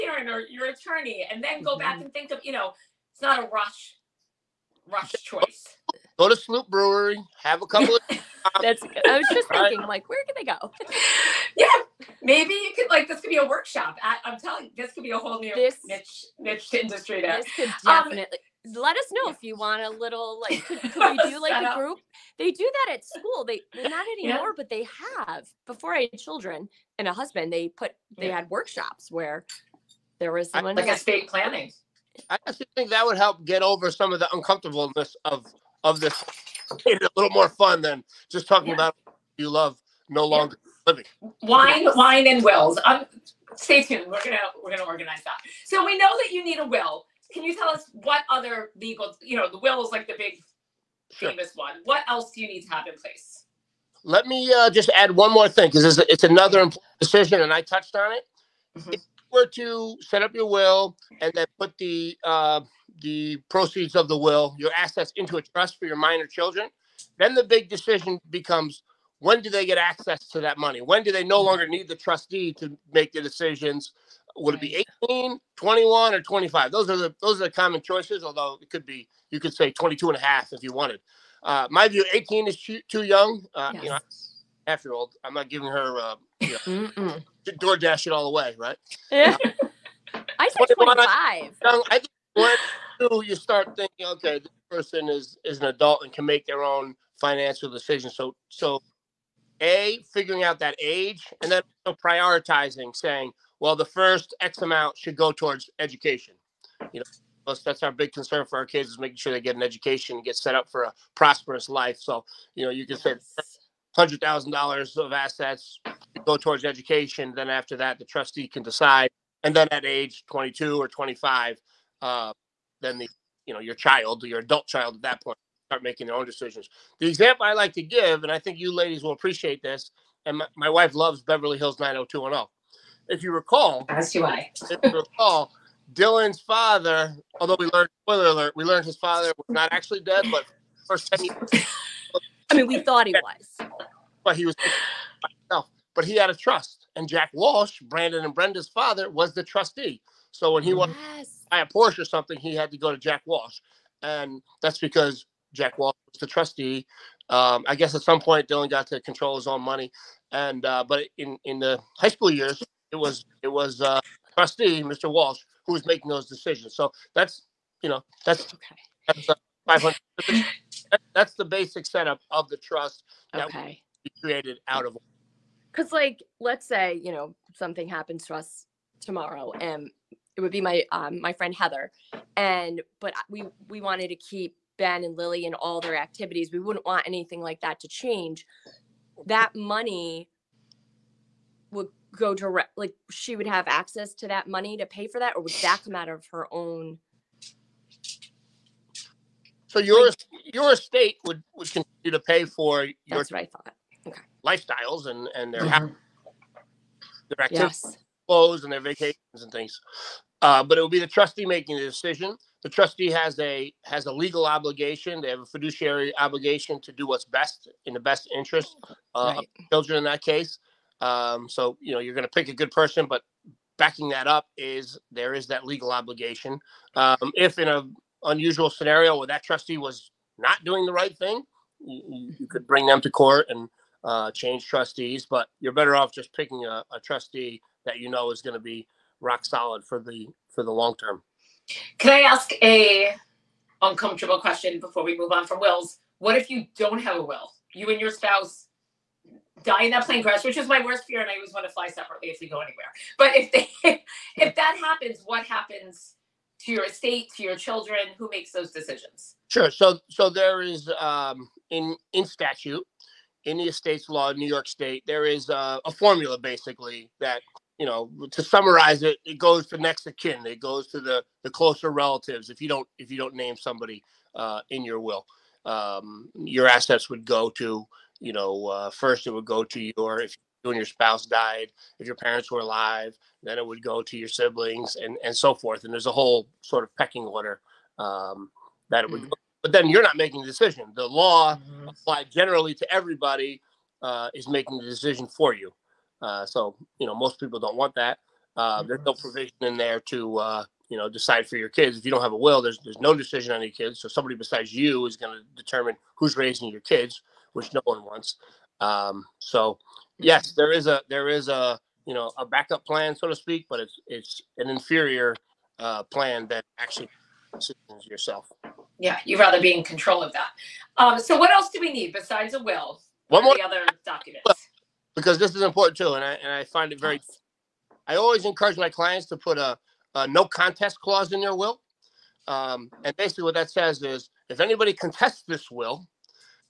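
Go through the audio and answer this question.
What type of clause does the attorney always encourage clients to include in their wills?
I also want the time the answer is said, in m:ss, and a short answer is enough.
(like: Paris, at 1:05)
no contest clause, at 5:30.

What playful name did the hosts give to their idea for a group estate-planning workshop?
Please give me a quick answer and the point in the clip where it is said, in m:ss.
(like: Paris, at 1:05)
Wine, wine, and wills, at 0:41.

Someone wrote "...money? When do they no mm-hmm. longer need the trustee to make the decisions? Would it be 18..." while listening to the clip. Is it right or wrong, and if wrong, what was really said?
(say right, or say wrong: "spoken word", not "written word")
right.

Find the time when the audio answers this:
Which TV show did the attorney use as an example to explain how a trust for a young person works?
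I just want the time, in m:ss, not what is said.
2:11.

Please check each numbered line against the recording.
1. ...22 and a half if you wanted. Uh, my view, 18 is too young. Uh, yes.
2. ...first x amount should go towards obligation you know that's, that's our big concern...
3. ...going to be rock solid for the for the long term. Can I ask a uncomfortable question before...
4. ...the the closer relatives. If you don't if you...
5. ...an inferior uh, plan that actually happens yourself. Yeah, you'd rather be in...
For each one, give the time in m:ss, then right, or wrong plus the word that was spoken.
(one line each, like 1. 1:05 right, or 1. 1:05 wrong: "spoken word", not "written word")
1. 1:19 right
2. 1:43 wrong: "education", not "obligation"
3. 3:58 right
4. 4:30 right
5. 5:14 wrong: "decisions", not "happens".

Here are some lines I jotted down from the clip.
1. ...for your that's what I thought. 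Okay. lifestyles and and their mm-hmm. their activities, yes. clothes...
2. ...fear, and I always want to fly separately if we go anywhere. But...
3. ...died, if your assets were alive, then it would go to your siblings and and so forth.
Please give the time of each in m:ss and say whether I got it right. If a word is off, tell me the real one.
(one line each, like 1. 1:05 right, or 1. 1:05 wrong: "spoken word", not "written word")
1. 3:22 right
2. 4:11 right
3. 4:41 wrong: "parents", not "assets".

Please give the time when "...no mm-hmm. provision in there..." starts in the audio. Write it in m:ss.
4:59.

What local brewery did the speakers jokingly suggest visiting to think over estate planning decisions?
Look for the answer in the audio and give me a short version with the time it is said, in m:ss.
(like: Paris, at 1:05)
Sloop Brewery, at 0:06.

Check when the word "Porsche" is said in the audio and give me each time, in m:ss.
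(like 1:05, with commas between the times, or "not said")
2:31.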